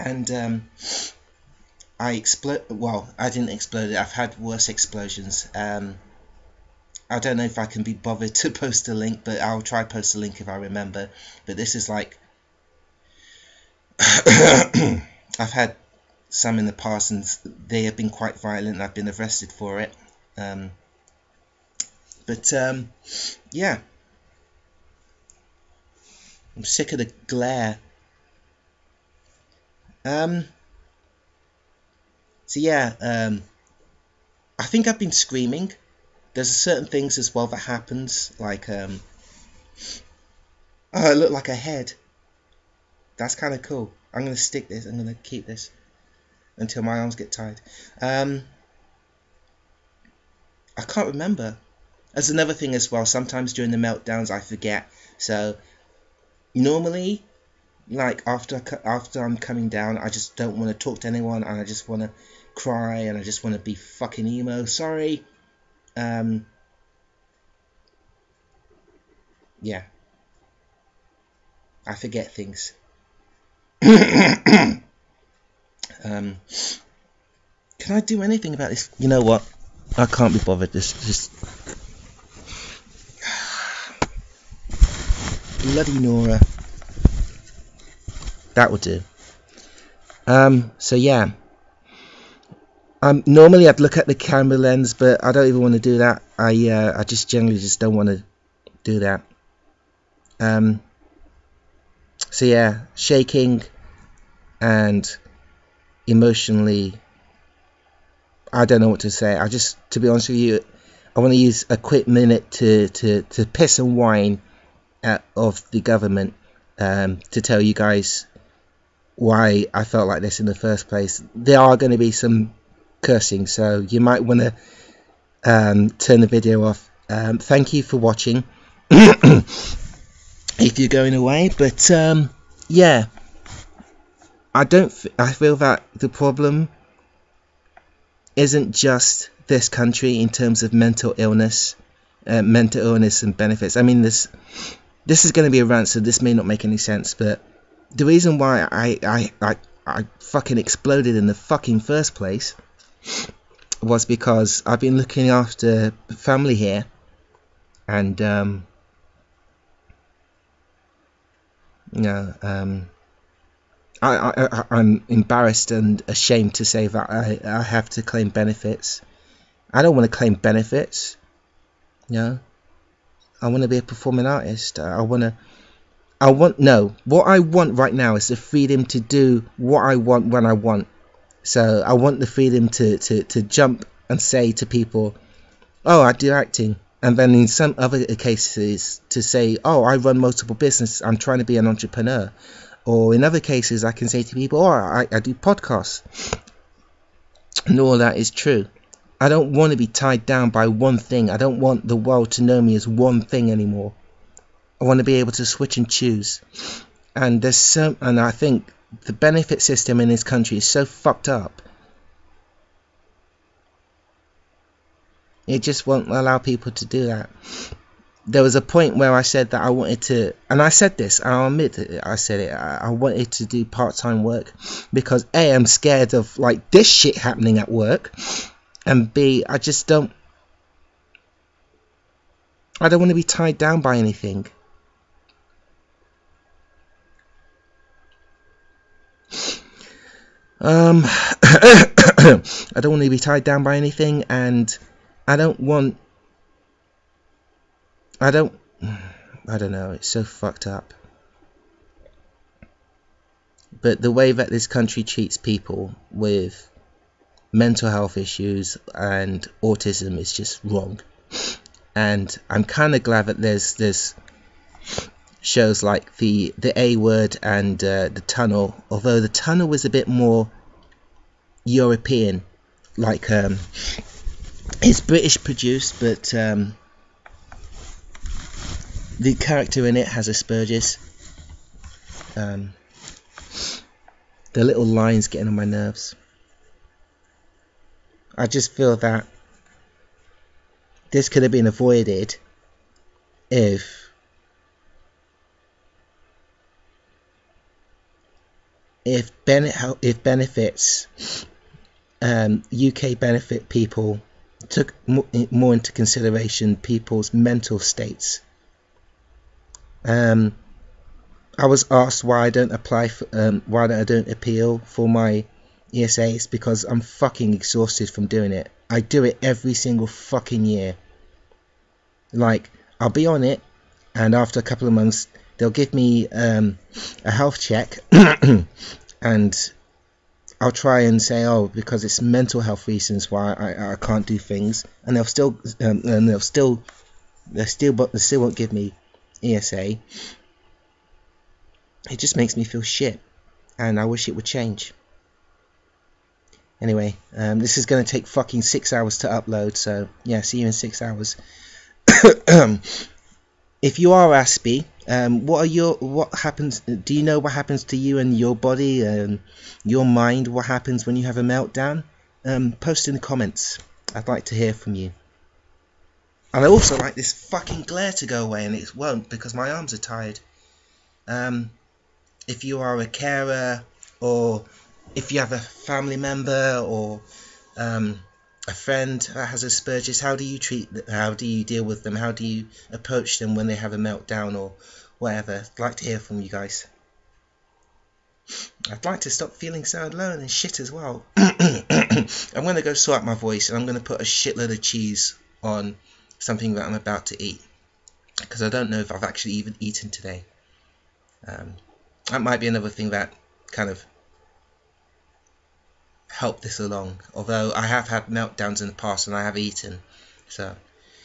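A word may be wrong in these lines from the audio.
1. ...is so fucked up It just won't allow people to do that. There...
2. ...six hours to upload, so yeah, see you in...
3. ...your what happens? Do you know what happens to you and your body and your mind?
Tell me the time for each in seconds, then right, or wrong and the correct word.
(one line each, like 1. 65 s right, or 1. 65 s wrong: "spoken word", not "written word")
1. 210 s right
2. 348 s right
3. 355 s right.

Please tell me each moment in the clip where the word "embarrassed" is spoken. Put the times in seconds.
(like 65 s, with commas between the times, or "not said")
165 s.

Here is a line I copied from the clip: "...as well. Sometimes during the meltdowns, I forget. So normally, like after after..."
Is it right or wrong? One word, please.
right.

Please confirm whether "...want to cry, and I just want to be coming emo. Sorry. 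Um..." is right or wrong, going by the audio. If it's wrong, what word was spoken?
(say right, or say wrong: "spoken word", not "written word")
wrong: "fucking", not "coming".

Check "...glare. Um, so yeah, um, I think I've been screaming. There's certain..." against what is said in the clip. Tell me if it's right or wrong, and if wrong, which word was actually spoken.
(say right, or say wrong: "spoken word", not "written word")
right.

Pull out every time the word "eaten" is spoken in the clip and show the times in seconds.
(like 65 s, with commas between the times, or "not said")
399 s, 409 s.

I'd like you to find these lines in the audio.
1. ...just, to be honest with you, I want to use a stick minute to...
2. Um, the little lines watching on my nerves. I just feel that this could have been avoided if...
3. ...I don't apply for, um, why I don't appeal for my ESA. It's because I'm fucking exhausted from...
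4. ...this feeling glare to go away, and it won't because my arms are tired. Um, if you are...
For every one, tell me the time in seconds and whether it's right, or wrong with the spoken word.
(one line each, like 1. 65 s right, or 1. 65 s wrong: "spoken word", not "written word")
1. 109 s wrong: "quick", not "stick"
2. 282 s wrong: "getting", not "watching"
3. 312 s right
4. 367 s wrong: "fucking", not "feeling".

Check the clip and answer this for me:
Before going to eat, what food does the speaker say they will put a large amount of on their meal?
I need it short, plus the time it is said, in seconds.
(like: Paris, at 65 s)
cheese, at 394 s.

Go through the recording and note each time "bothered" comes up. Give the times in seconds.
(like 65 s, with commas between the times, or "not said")
7 s, 80 s.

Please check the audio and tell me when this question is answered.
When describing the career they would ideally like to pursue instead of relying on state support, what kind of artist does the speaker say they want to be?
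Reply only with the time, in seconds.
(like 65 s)
173 s.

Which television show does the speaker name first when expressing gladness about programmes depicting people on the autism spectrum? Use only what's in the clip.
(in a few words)
The A Word.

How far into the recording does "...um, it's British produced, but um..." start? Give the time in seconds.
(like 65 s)
273 s.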